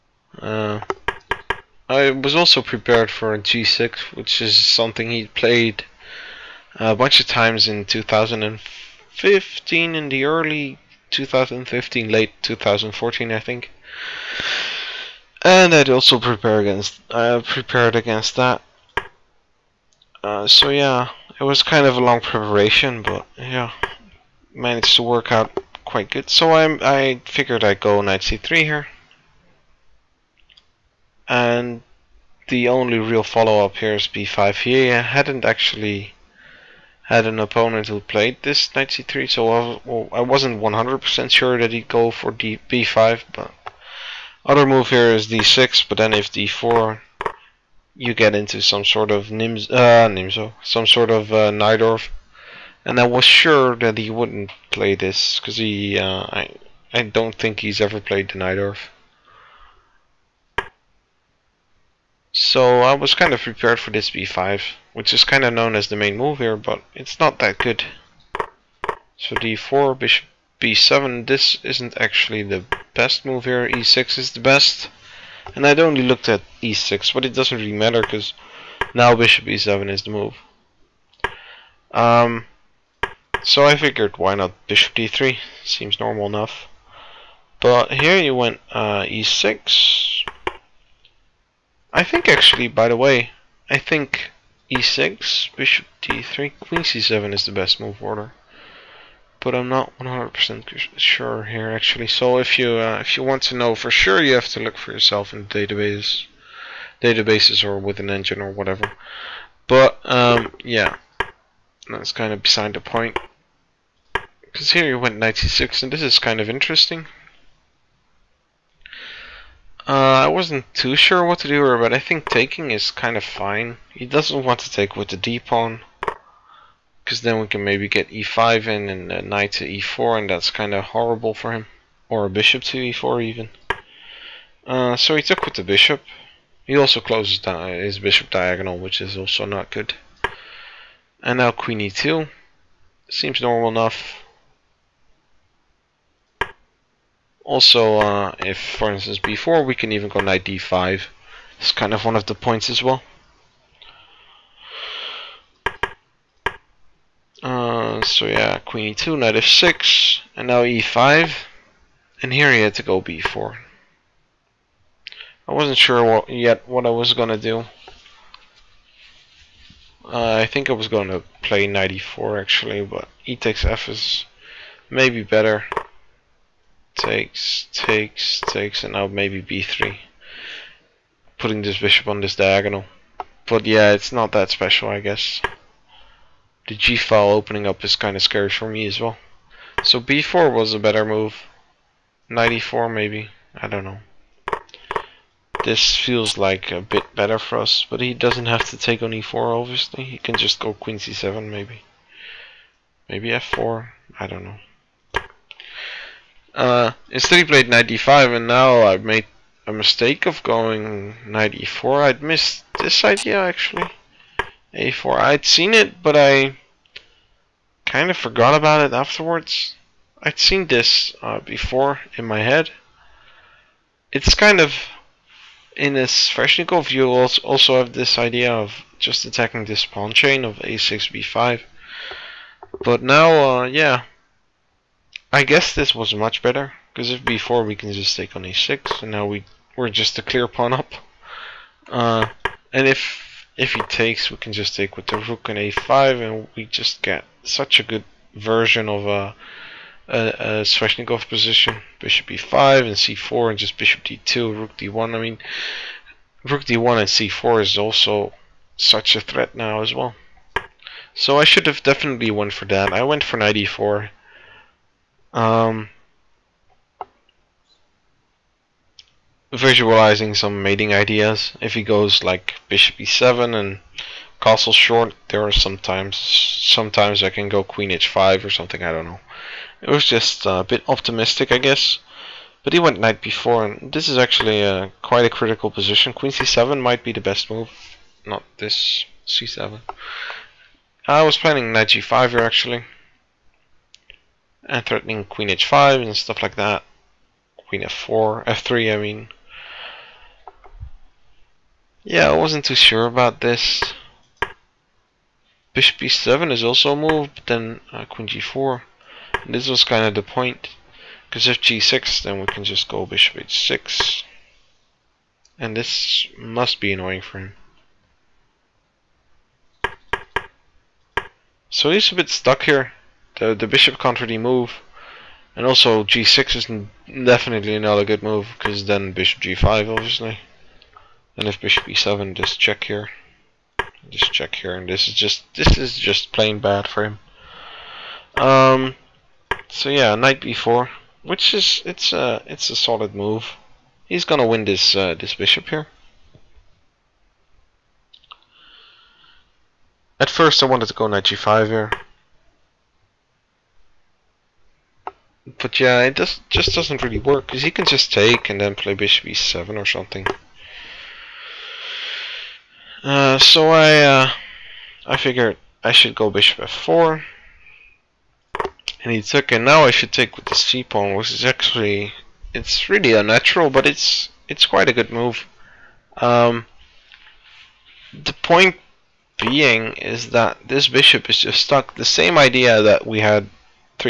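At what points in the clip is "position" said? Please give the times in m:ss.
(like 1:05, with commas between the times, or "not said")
4:11, 4:45.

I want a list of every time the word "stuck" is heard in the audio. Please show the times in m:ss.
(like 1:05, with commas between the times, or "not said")
5:22, 6:21.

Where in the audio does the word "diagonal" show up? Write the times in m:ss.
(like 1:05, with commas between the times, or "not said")
2:18, 3:02.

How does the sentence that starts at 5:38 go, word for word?
Um, so yeah, knight b4, which is it's a it's a solid move.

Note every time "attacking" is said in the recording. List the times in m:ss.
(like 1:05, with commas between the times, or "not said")
3:49.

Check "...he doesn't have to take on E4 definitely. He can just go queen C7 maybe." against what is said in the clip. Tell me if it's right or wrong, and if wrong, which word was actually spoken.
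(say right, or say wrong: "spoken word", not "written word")
wrong: "obviously", not "definitely".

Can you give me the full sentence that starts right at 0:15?
And I'd also prepare against, uh, prepared against that.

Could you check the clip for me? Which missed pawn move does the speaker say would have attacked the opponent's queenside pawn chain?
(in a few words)
a4.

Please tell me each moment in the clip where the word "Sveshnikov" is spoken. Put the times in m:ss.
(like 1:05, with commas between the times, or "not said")
3:46, 4:10.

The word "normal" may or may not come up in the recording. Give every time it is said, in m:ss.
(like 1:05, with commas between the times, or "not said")
1:25, 2:23.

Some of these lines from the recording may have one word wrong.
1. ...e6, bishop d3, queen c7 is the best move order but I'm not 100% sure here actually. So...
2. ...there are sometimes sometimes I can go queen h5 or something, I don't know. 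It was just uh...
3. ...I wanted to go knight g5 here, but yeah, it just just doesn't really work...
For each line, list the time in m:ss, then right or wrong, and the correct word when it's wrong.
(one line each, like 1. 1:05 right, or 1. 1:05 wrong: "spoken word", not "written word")
1. 1:34 right
2. 4:35 right
3. 5:50 right.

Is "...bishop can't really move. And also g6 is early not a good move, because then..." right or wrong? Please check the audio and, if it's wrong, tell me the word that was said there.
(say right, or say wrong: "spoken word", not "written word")
wrong: "definitely", not "early".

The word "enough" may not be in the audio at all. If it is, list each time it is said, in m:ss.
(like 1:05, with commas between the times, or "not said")
1:26, 2:23.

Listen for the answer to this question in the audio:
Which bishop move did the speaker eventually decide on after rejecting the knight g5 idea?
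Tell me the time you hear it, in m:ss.
6:06.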